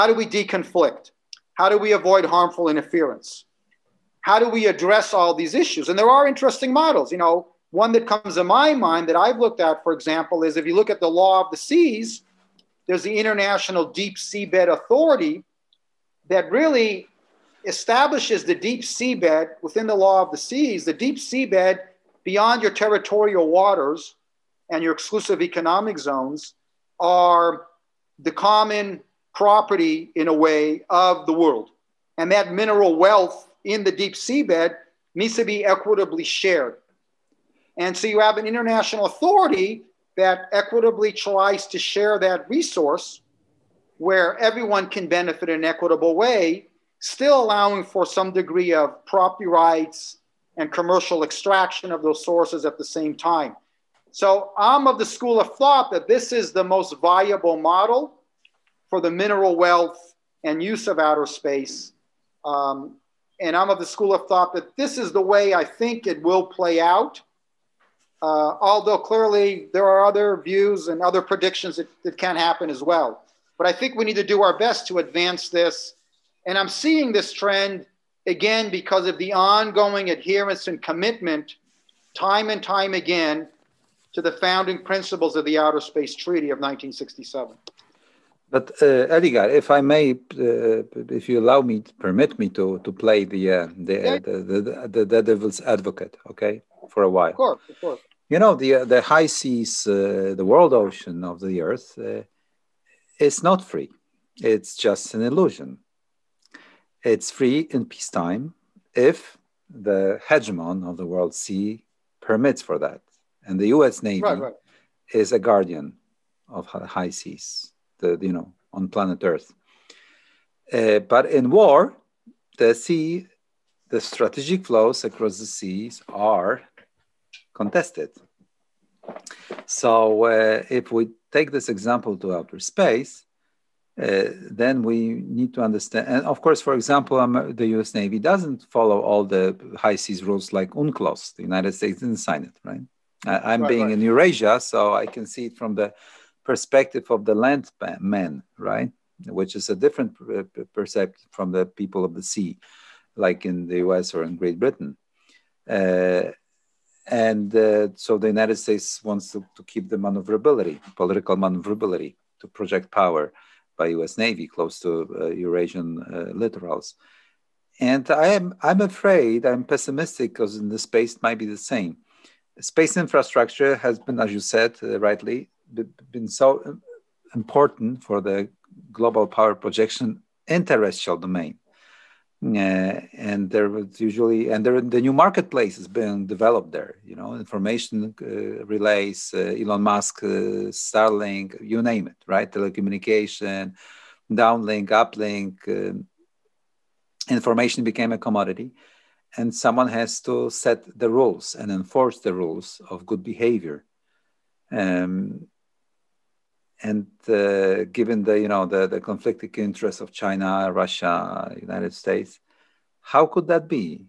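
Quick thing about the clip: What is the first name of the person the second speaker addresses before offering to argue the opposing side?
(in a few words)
Edgar.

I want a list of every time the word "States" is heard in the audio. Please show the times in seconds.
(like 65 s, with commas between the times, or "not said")
141 s, 158 s, 212 s.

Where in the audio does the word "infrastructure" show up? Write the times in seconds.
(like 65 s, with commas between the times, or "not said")
172 s.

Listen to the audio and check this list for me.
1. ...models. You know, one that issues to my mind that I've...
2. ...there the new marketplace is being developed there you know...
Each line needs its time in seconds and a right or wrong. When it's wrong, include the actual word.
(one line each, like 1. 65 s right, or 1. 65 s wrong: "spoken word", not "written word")
1. 6 s wrong: "comes", not "issues"
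2. 184 s right.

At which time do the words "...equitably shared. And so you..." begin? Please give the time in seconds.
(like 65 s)
35 s.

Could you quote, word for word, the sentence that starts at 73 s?
But I think we need to do our best to advance this.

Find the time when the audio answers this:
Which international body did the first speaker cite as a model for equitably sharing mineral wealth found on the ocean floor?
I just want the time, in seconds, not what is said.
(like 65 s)
13 s.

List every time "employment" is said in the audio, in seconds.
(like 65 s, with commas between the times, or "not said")
not said.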